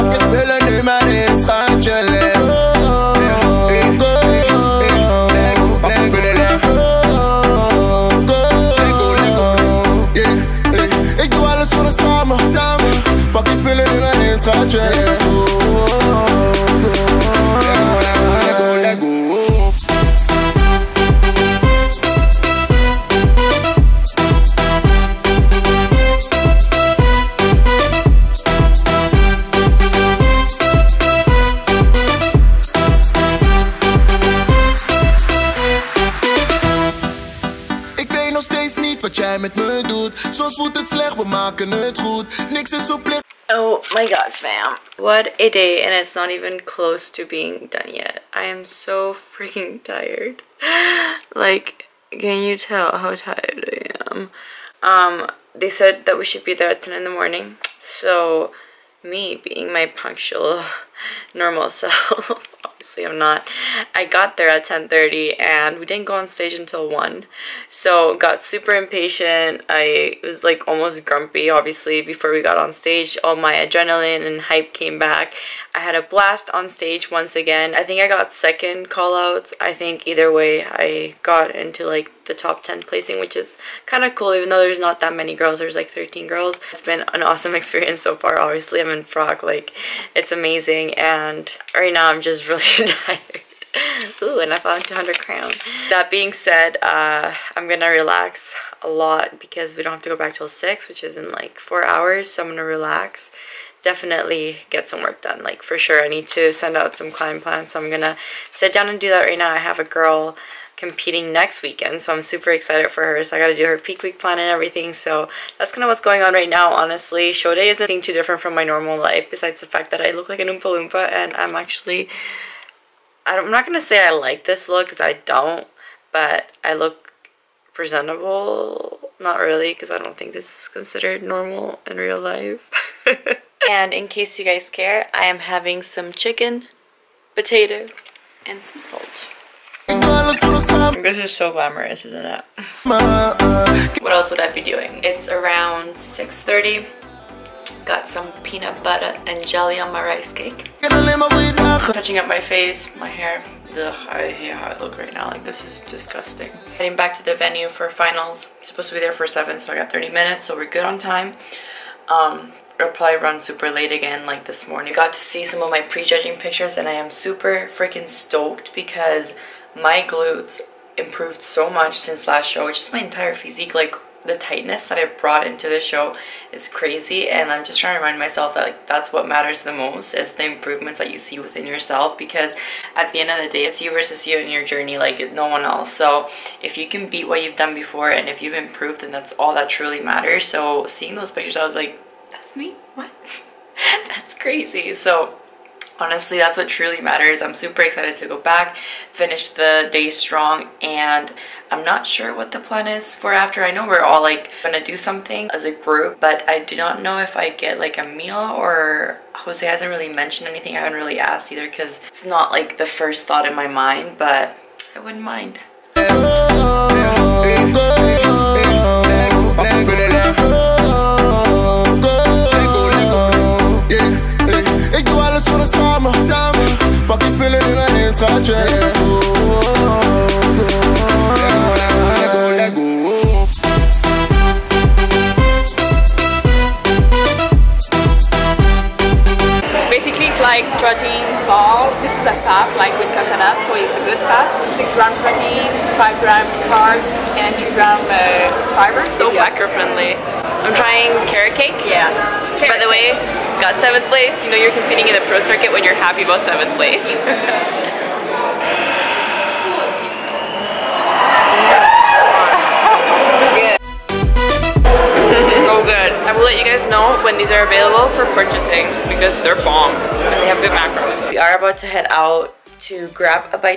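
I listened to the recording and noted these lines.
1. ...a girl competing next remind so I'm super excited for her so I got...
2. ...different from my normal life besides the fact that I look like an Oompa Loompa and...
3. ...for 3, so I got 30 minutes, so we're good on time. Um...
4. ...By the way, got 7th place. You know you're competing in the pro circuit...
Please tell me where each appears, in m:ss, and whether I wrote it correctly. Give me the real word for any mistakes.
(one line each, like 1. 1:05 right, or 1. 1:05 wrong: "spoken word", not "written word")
1. 1:49 wrong: "weekend", not "remind"
2. 1:58 right
3. 2:39 wrong: "7", not "3"
4. 4:12 right.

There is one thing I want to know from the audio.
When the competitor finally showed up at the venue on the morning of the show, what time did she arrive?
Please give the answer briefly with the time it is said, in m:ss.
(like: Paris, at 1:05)
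10:30, at 1:04.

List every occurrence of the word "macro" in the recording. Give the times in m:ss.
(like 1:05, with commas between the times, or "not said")
4:09, 4:30.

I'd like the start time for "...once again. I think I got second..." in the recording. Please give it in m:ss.
1:17.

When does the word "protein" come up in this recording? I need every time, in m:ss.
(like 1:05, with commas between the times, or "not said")
4:00, 4:05.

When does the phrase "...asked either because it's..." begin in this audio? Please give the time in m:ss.
3:31.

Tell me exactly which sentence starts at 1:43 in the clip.
Definitely get some work done, like for sure.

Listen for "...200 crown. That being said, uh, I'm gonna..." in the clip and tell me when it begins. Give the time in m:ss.
1:34.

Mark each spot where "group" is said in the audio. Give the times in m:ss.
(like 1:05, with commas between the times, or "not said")
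3:25.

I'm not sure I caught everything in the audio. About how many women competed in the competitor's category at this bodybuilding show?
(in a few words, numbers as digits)
13.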